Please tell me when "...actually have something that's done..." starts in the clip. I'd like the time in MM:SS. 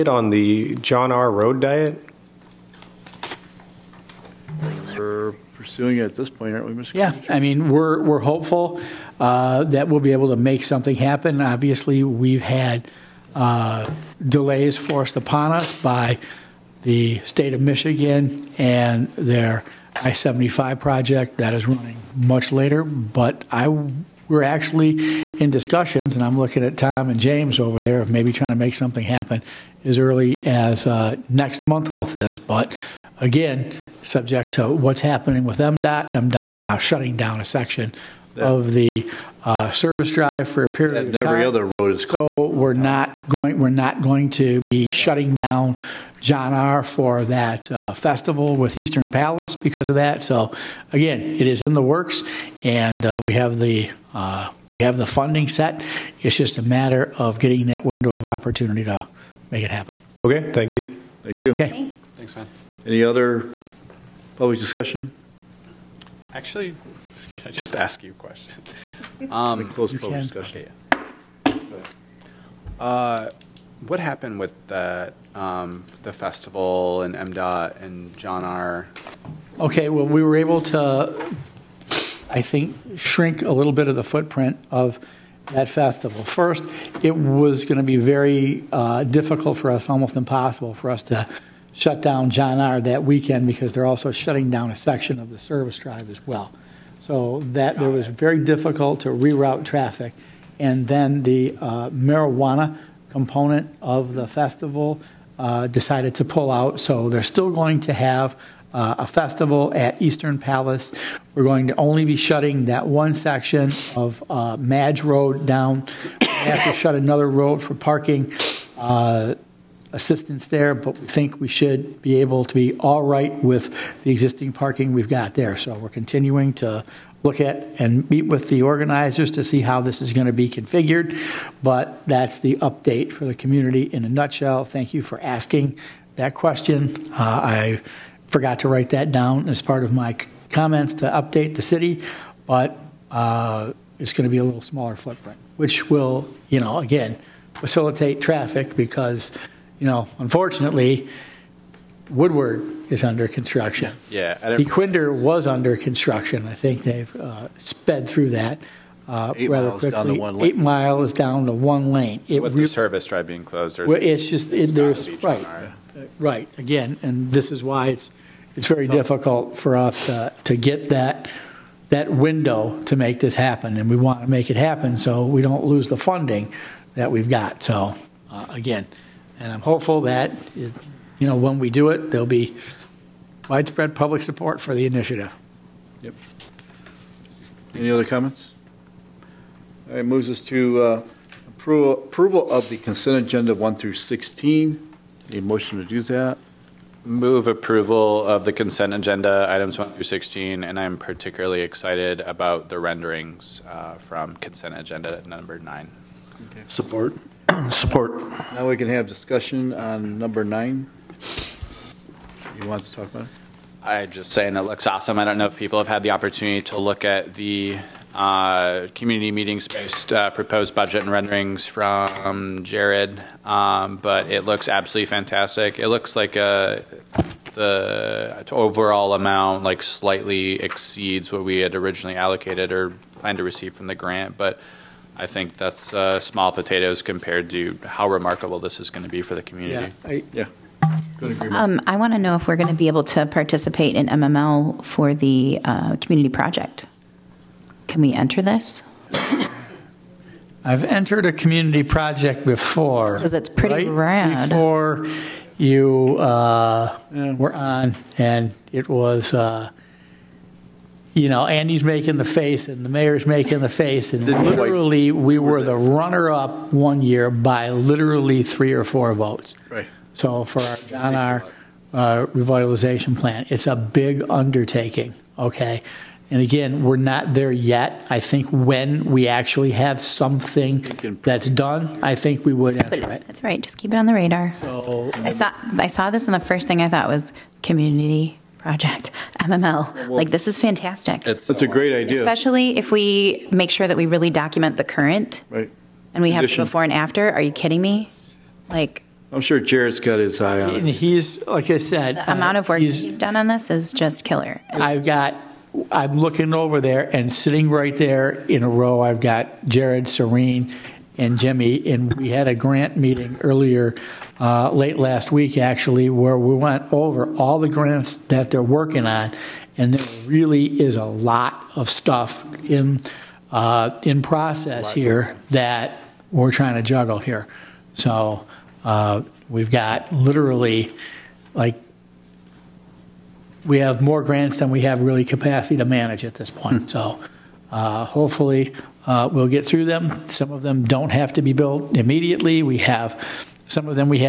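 04:39.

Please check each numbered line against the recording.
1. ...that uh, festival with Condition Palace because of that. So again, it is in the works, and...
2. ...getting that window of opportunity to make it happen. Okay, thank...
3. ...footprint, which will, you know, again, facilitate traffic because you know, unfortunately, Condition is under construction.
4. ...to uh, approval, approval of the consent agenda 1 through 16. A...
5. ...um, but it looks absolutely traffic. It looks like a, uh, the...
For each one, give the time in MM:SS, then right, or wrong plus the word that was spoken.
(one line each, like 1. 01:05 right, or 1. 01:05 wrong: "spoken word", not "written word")
1. 00:47 wrong: "Eastern", not "Condition"
2. 00:57 right
3. 02:24 wrong: "Woodward", not "Condition"
4. 03:10 right
5. 03:43 wrong: "fantastic", not "traffic".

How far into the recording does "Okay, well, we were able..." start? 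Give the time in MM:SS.
01:19.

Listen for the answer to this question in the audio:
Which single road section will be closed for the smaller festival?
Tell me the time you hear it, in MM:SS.
01:54.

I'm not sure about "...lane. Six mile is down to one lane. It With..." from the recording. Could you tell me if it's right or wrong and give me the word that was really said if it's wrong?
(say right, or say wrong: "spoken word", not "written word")
wrong: "Eight", not "Six".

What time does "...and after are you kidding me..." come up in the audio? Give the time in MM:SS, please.
04:56.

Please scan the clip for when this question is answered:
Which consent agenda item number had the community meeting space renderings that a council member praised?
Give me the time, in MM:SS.
03:25.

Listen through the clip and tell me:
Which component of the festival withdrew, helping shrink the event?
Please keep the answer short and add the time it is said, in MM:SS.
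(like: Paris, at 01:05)
marijuana, at 01:41.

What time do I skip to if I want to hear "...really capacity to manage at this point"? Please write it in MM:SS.
05:35.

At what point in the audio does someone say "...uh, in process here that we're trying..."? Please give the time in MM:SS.
05:23.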